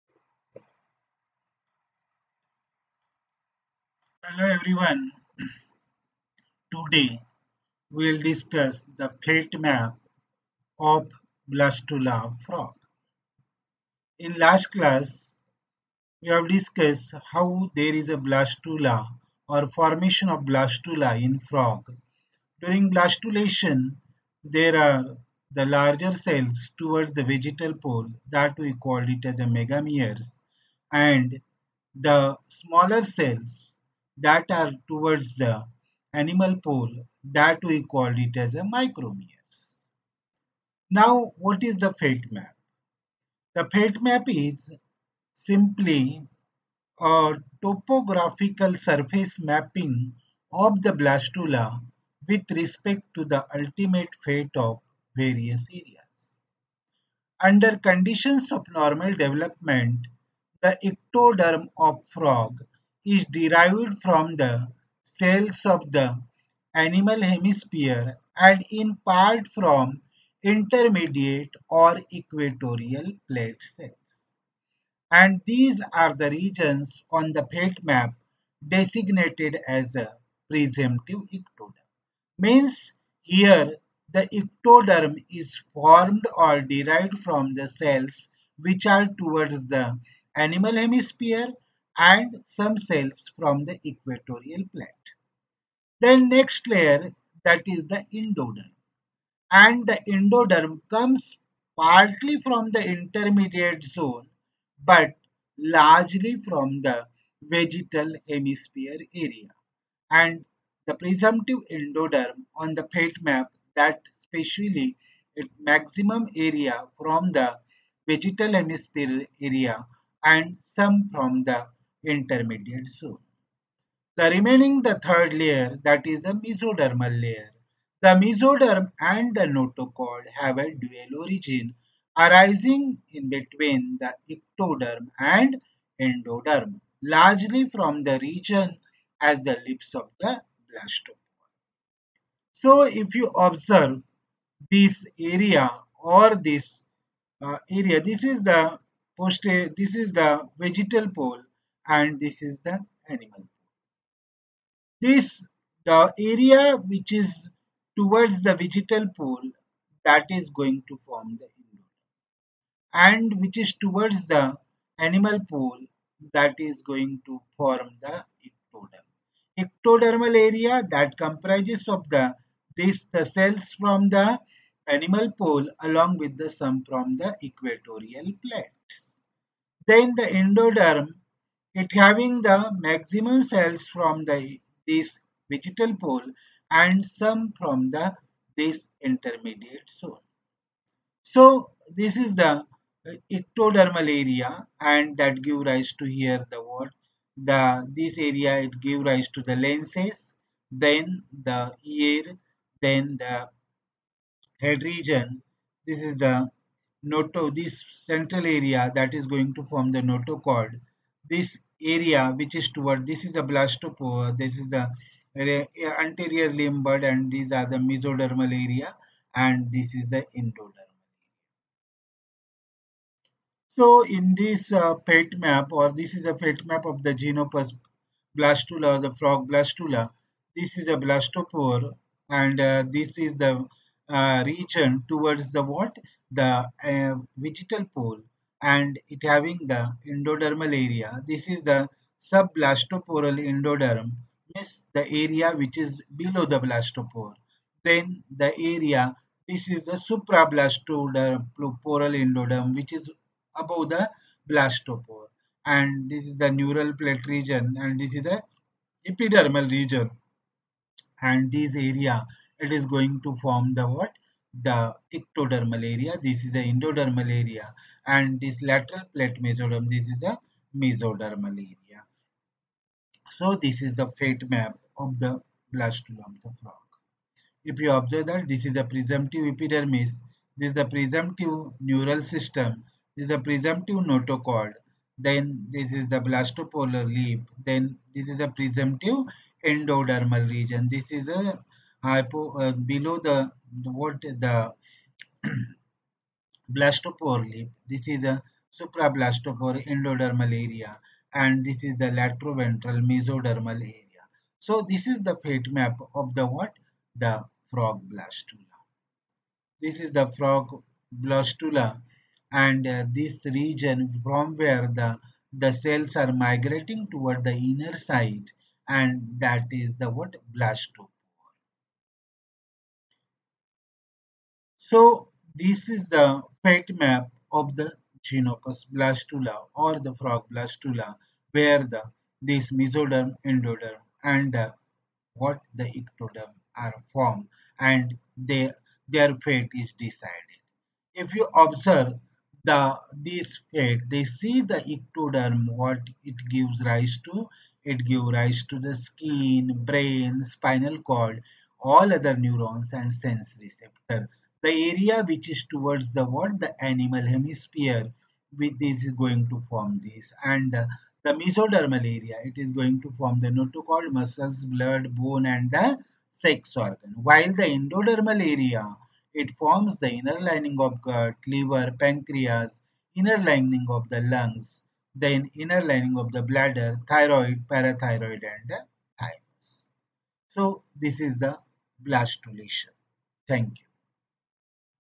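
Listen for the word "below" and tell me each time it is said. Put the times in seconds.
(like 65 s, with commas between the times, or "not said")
246 s, 292 s.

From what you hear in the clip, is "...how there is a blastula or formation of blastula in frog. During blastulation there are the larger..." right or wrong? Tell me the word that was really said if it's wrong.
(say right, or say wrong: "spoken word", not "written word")
right.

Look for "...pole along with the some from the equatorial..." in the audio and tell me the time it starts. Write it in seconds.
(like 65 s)
175 s.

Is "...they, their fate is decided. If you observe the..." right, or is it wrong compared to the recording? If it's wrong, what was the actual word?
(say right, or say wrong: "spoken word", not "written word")
right.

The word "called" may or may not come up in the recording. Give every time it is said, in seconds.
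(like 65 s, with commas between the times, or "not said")
28 s, 37 s.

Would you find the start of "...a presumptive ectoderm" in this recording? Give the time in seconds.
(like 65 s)
79 s.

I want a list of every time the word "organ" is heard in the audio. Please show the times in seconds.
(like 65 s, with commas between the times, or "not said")
366 s.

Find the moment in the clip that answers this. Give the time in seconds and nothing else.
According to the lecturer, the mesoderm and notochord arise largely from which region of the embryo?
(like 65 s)
139 s.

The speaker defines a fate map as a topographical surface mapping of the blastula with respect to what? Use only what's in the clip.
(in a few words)
ultimate fate of various areas.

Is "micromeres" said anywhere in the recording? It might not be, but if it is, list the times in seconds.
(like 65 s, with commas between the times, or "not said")
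38 s.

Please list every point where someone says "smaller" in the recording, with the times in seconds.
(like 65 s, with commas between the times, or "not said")
32 s.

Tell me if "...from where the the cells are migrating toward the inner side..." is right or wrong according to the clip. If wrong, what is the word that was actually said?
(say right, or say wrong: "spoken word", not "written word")
right.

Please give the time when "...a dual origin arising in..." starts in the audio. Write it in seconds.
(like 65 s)
130 s.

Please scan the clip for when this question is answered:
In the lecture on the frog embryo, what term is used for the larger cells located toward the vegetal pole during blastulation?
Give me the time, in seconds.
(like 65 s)
29 s.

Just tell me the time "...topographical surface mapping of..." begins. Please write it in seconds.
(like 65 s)
47 s.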